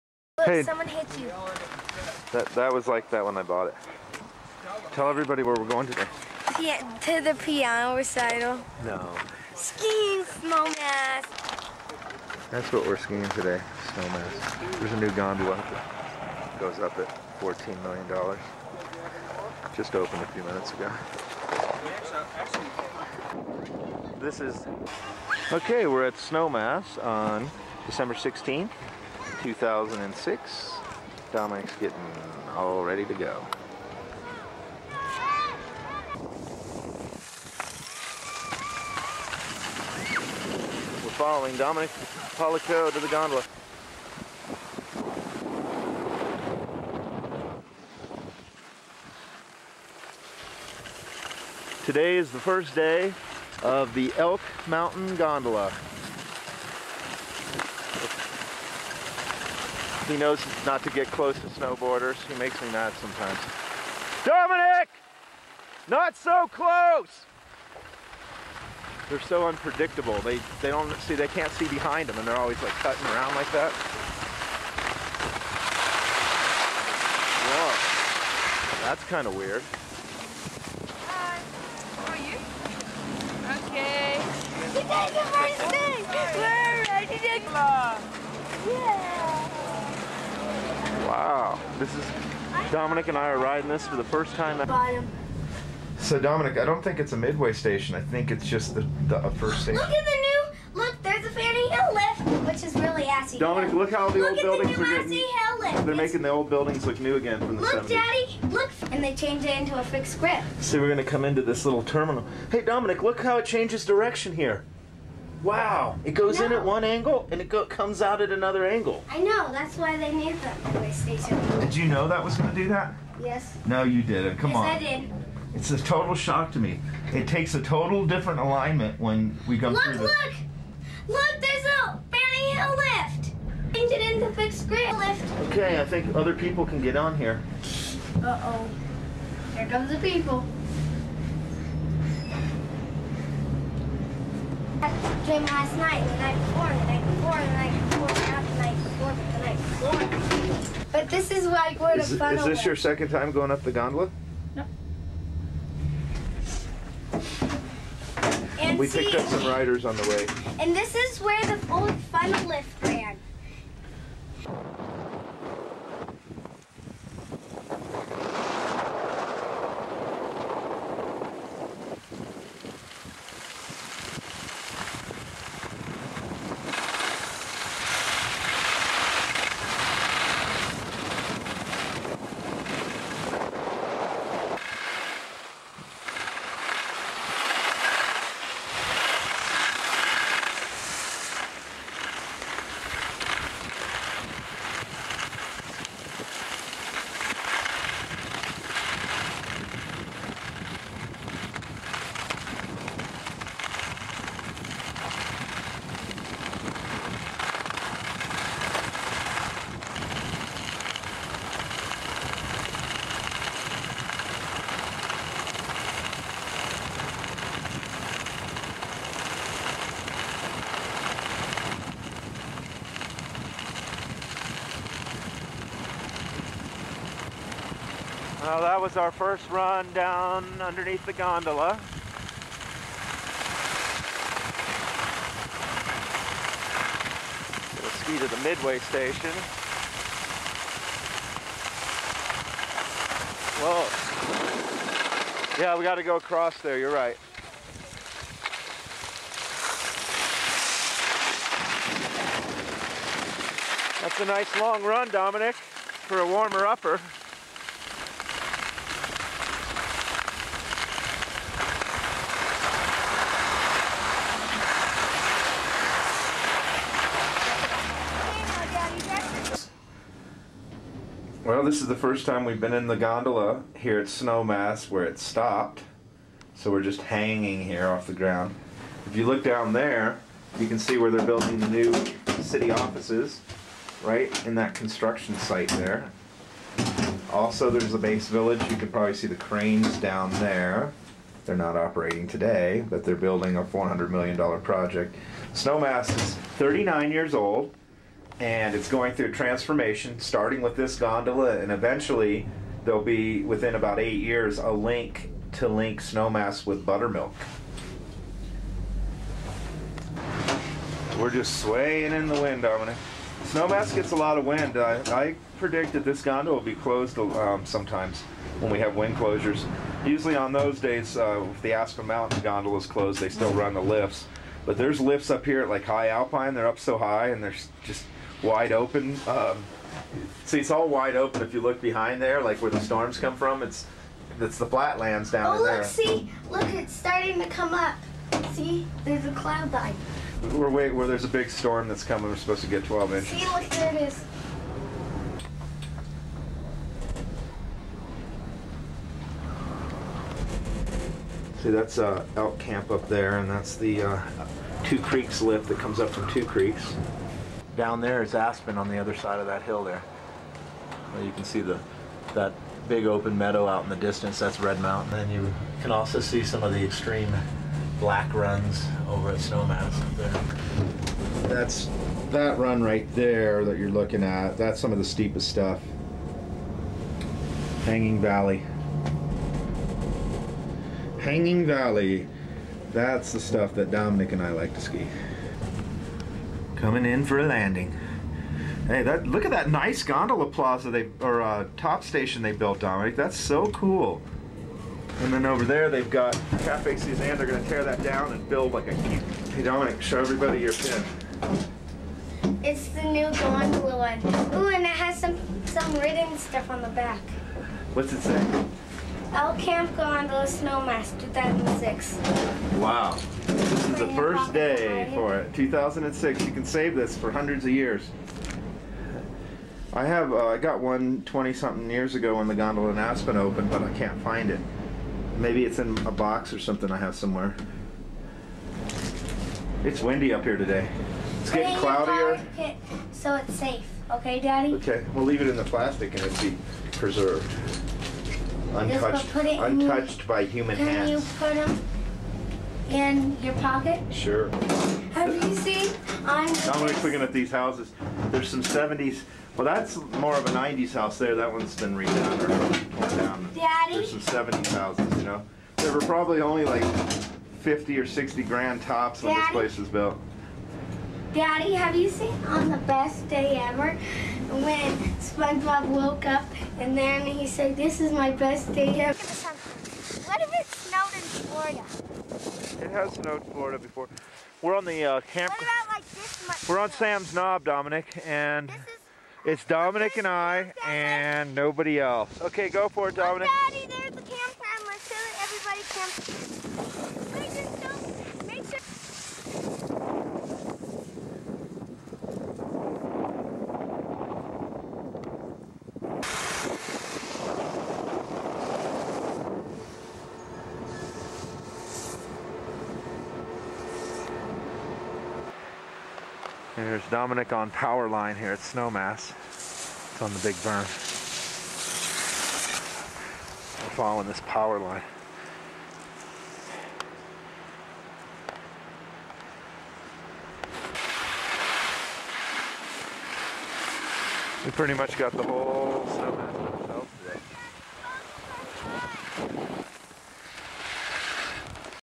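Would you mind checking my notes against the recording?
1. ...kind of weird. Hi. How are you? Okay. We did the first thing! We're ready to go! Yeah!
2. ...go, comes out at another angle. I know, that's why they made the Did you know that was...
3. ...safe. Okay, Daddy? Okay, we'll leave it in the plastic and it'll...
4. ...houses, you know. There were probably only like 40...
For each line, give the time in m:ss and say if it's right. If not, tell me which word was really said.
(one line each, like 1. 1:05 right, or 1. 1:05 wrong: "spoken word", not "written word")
1. 1:19 right
2. 1:57 right
3. 7:13 right
4. 7:34 wrong: "50", not "40".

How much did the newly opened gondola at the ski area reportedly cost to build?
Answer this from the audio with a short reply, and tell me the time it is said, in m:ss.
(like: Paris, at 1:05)
$14 million, at 0:17.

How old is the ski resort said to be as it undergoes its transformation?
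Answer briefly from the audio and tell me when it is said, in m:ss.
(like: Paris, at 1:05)
39 years, at 4:56.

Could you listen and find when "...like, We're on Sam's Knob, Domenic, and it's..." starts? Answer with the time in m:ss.
7:55.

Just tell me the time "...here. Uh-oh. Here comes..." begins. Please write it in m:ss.
2:17.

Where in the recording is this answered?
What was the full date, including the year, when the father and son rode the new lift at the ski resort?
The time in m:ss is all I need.
0:27.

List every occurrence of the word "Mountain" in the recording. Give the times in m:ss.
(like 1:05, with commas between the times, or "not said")
0:54, 5:22, 6:04.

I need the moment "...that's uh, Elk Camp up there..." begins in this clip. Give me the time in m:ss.
5:51.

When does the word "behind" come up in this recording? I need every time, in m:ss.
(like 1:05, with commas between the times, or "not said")
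1:11, 5:31.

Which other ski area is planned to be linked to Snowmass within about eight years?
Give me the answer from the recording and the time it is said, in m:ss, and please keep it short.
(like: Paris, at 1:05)
Buttermilk, at 5:06.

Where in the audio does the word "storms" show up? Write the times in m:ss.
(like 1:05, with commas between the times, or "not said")
5:32, 5:41.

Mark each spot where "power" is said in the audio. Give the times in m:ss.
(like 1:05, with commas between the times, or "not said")
8:27, 8:34.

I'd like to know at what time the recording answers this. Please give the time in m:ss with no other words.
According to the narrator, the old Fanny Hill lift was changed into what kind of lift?
1:49.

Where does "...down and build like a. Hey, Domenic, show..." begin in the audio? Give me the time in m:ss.
6:38.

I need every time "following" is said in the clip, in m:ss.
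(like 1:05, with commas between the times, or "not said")
0:41, 8:33.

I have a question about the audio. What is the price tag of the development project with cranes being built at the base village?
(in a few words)
$400 million.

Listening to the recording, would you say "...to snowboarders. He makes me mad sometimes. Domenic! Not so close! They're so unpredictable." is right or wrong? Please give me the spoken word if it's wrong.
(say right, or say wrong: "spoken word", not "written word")
right.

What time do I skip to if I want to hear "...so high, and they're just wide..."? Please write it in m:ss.
5:26.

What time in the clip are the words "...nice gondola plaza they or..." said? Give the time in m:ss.
6:29.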